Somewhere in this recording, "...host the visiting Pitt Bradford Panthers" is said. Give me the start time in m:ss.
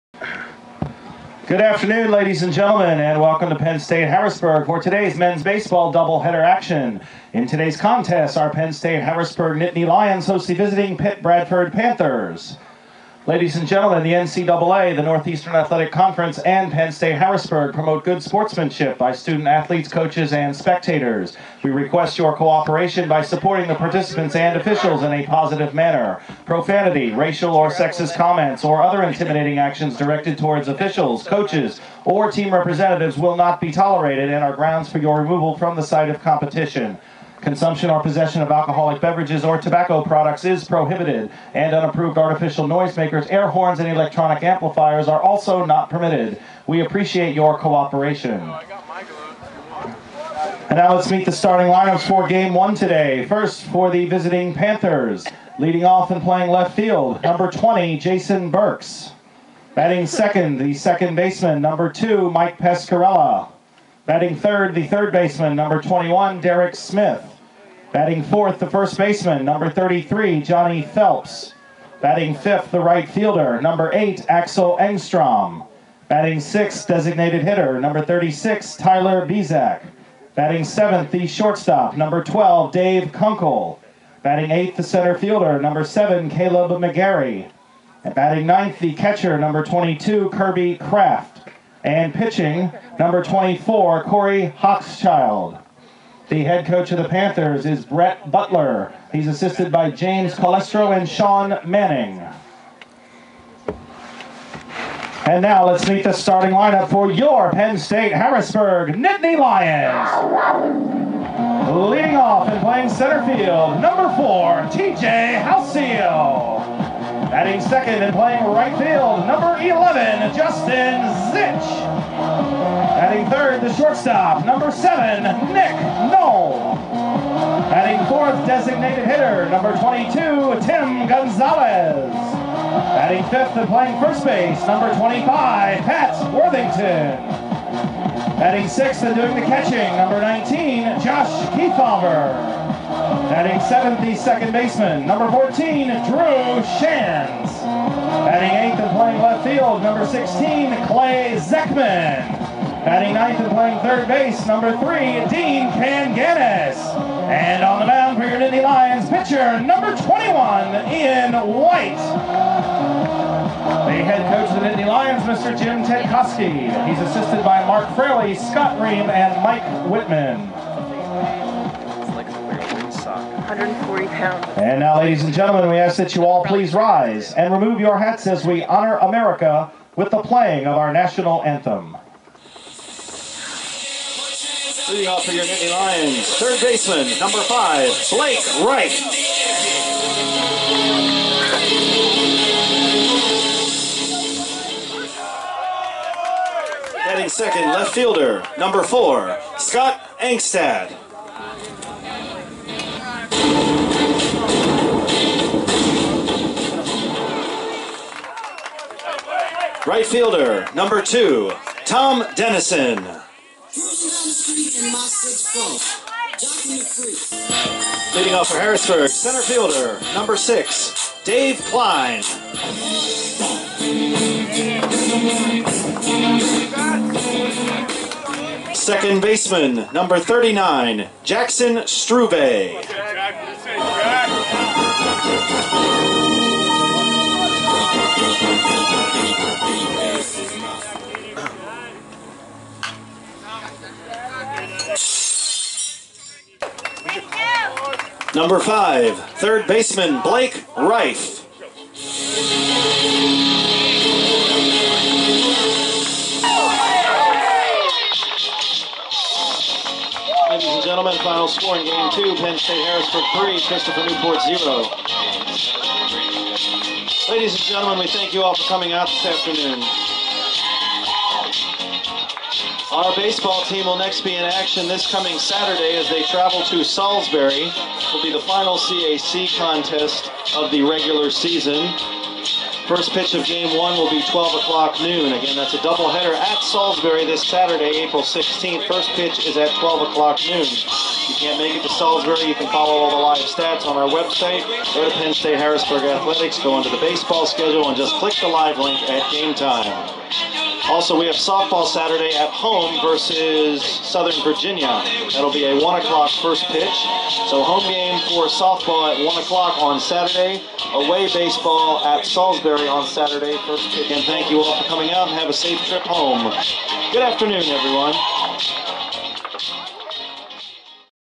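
0:10.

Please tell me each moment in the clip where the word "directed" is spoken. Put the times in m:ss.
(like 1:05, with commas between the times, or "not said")
0:29.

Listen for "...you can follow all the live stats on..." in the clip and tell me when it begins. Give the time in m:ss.
4:52.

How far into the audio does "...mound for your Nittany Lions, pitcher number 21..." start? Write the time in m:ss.
2:37.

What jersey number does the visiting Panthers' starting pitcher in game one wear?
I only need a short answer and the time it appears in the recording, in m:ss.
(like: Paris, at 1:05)
24, at 1:32.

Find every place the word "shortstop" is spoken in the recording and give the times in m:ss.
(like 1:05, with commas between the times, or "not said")
1:21, 2:03.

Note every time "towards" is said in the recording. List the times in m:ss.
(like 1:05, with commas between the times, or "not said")
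0:30.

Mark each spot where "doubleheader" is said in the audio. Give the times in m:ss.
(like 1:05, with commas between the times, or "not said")
0:05, 4:45.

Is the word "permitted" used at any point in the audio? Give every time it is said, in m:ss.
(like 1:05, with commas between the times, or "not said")
0:45.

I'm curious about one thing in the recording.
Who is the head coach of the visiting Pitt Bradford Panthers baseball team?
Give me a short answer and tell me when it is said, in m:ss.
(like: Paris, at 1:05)
Brett Butler, at 1:37.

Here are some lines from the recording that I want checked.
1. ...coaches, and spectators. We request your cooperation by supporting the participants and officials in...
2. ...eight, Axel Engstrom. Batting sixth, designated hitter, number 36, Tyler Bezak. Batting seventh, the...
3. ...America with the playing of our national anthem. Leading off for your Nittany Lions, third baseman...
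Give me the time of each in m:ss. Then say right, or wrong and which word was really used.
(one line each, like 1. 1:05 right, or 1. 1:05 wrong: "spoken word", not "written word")
1. 0:19 right
2. 1:13 right
3. 2:58 right.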